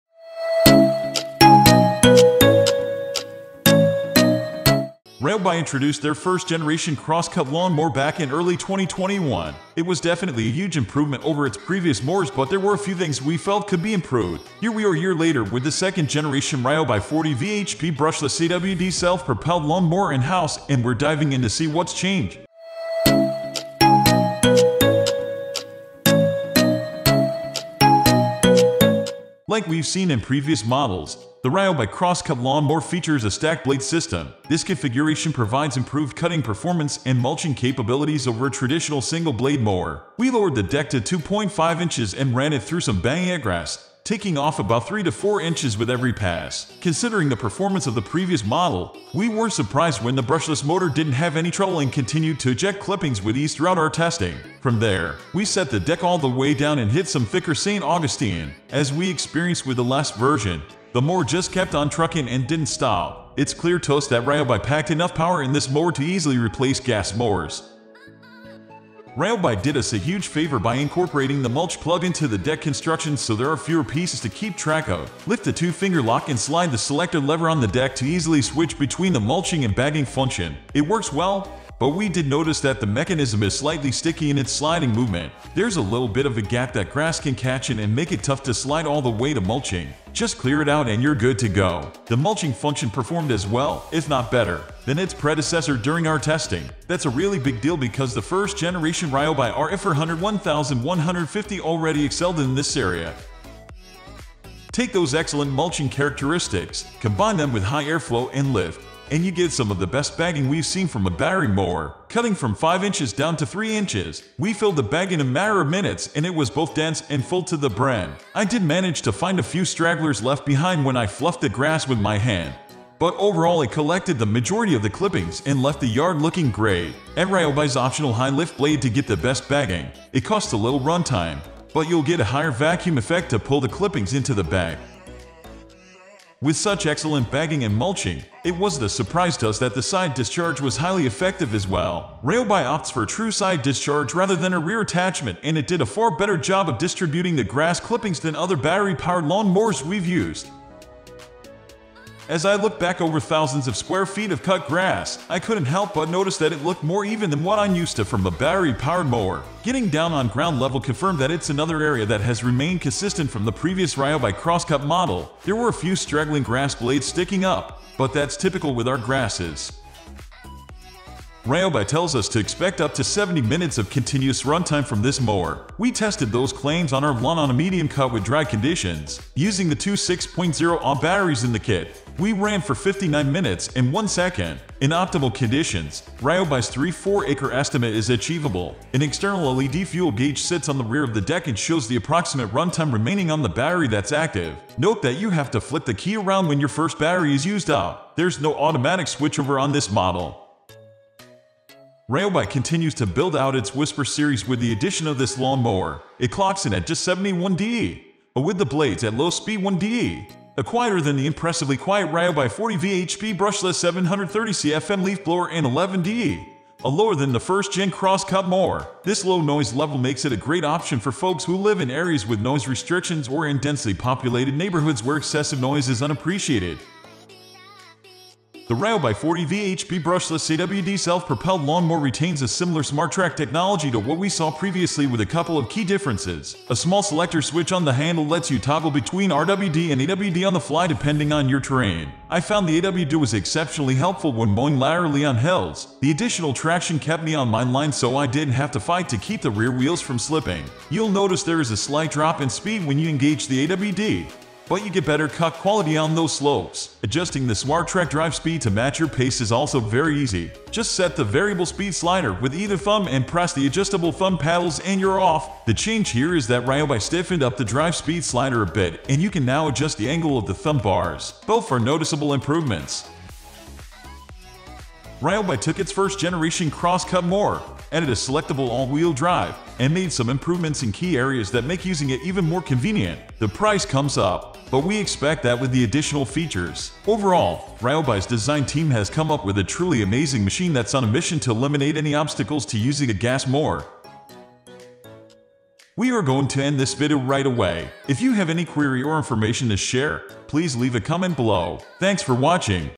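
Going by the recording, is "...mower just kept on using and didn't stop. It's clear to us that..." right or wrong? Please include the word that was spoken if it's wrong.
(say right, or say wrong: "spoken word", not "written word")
wrong: "trucking", not "using".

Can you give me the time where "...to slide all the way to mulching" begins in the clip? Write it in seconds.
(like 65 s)
88 s.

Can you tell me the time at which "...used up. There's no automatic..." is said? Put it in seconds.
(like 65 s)
197 s.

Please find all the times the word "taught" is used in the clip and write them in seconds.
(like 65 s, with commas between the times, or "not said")
not said.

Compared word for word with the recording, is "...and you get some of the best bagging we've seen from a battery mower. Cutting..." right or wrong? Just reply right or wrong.
right.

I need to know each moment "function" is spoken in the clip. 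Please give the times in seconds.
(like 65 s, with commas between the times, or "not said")
80 s, 92 s.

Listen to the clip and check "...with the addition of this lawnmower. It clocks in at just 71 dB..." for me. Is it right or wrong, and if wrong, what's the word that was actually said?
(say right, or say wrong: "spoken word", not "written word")
right.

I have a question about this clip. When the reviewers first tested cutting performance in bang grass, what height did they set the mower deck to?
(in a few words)
2.5 inches.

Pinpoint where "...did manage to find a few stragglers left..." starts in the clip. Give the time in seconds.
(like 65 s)
118 s.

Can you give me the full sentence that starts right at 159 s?
Getting down on ground level confirmed that it's another area that has remained consistent from the previous Ryobi by crosscut model.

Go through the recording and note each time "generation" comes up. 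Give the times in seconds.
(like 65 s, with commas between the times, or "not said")
6 s, 16 s, 98 s, 276 s.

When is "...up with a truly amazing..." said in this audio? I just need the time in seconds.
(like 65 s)
289 s.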